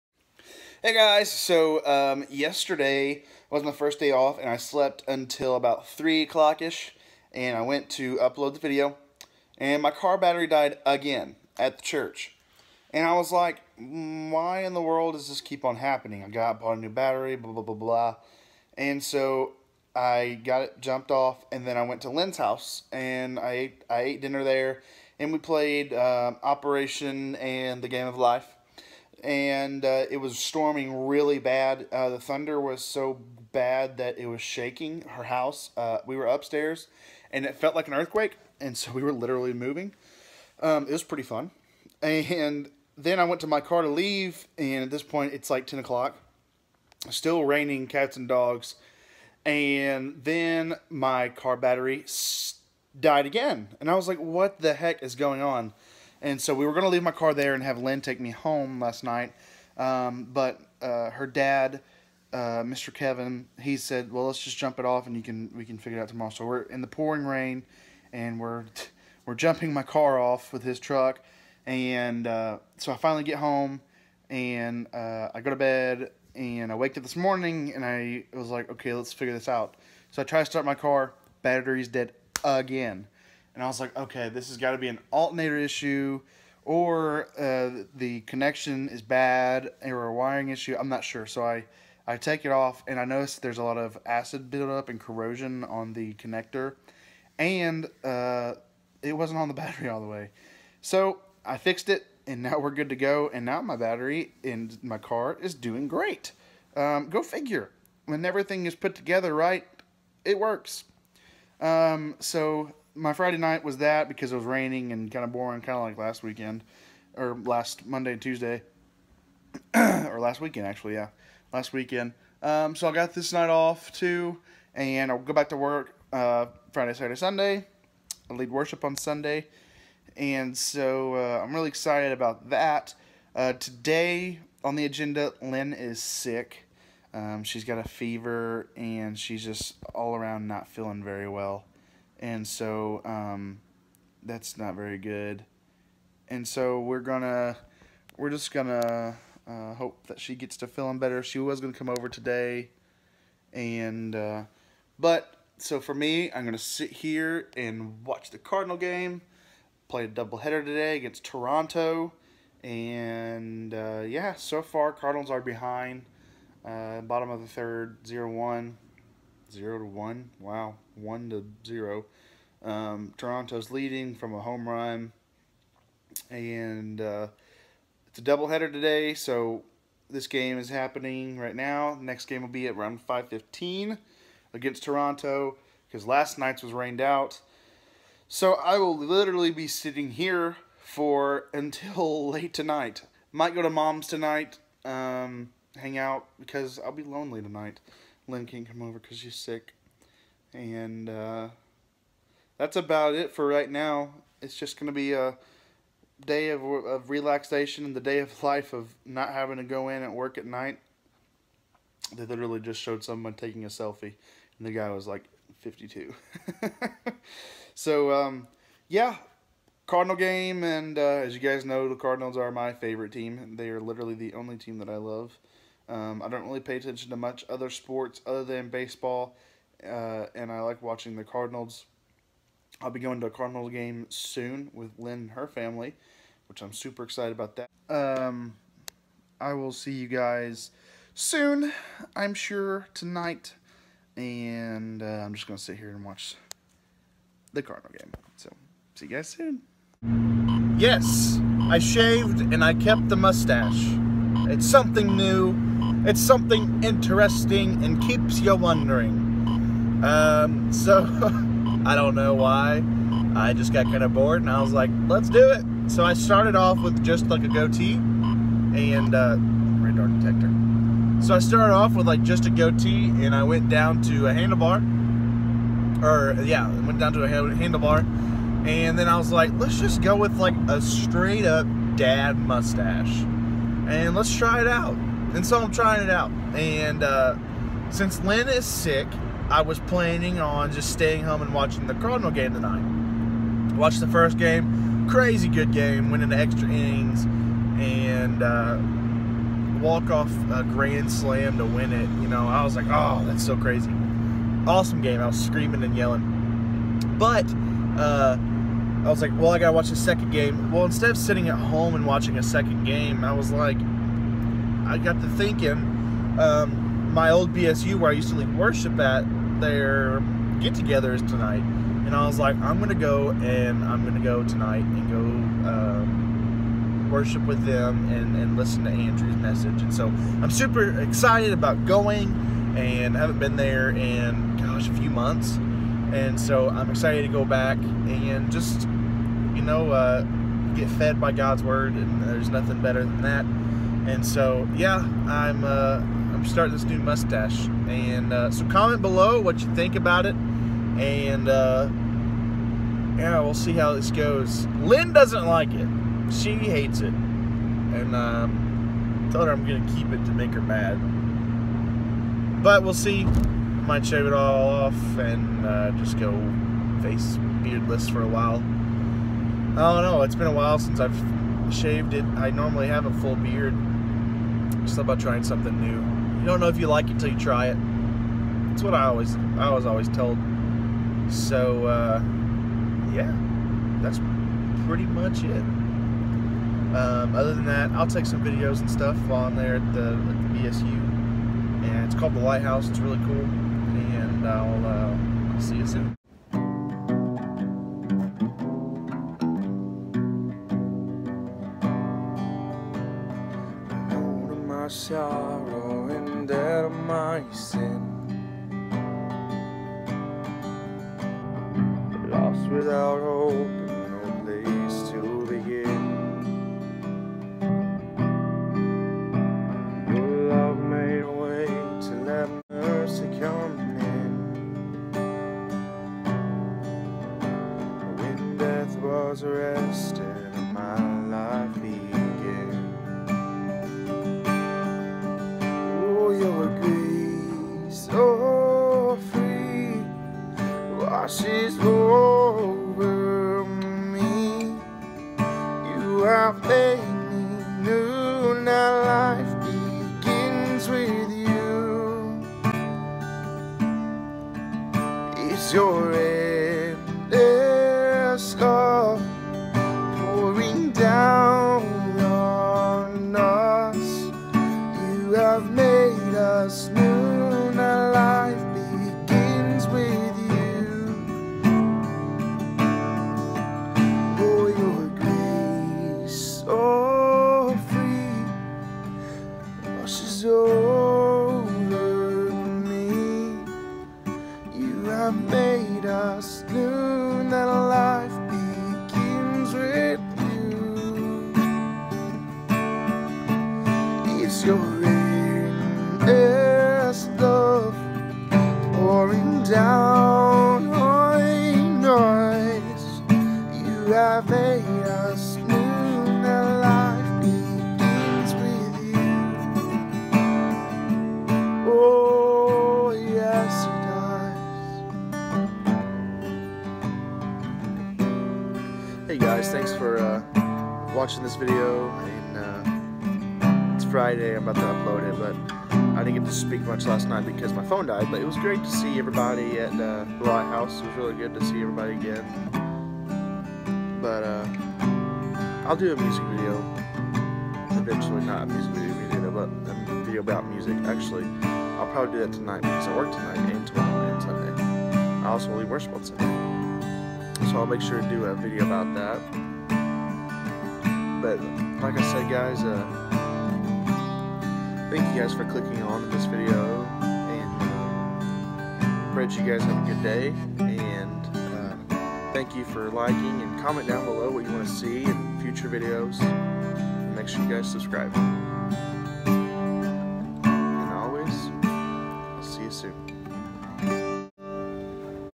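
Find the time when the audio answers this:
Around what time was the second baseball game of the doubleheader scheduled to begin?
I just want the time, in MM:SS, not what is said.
03:03.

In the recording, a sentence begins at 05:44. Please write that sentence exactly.
And so, yeah, I'm uh, I'm starting this new mustache.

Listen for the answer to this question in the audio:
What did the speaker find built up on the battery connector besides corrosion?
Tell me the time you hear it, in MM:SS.
01:34.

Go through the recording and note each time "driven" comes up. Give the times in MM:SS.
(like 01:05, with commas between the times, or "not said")
not said.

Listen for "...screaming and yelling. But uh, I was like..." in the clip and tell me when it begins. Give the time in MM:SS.
05:05.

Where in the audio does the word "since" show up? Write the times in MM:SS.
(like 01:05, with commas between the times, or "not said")
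04:47, 06:10.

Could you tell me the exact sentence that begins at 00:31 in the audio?
Uh, the thunder was so bad that it was shaking her house.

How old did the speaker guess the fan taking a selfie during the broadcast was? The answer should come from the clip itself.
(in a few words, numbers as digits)
52.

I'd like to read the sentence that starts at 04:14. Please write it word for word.
It's something new it's something interesting and keeps you wondering.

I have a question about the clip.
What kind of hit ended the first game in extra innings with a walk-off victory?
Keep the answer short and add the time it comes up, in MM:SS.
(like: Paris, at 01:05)
grand slam, at 05:00.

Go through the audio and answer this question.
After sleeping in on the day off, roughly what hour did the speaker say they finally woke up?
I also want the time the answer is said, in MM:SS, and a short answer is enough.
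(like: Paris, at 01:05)
3 o'clock, at 00:05.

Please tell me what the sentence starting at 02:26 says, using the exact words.
And so we're gonna, we're just gonna uh, hope that she gets to feeling better.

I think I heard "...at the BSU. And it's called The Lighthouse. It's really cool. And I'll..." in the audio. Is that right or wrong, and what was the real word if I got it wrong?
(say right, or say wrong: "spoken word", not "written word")
right.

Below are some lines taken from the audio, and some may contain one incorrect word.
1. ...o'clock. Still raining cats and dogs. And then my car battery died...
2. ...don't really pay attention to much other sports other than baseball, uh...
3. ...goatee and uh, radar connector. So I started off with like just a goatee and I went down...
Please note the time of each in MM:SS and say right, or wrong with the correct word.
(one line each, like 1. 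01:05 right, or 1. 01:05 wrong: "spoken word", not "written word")
1. 00:45 right
2. 03:46 right
3. 04:27 wrong: "detector", not "connector".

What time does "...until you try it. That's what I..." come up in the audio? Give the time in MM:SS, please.
06:17.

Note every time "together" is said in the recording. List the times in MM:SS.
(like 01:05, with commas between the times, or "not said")
01:48, 05:20.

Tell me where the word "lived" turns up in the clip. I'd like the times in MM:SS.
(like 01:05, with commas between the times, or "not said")
not said.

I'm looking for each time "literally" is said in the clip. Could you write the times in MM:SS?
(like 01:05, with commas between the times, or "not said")
00:39, 03:08, 03:32, 03:43.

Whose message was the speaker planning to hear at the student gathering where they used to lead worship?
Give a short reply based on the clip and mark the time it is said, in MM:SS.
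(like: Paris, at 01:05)
Andrew, at 05:28.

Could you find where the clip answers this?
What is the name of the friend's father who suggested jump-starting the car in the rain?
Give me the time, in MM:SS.
01:02.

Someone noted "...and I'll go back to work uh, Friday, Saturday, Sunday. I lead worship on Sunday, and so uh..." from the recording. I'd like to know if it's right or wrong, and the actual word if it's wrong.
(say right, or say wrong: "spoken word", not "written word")
right.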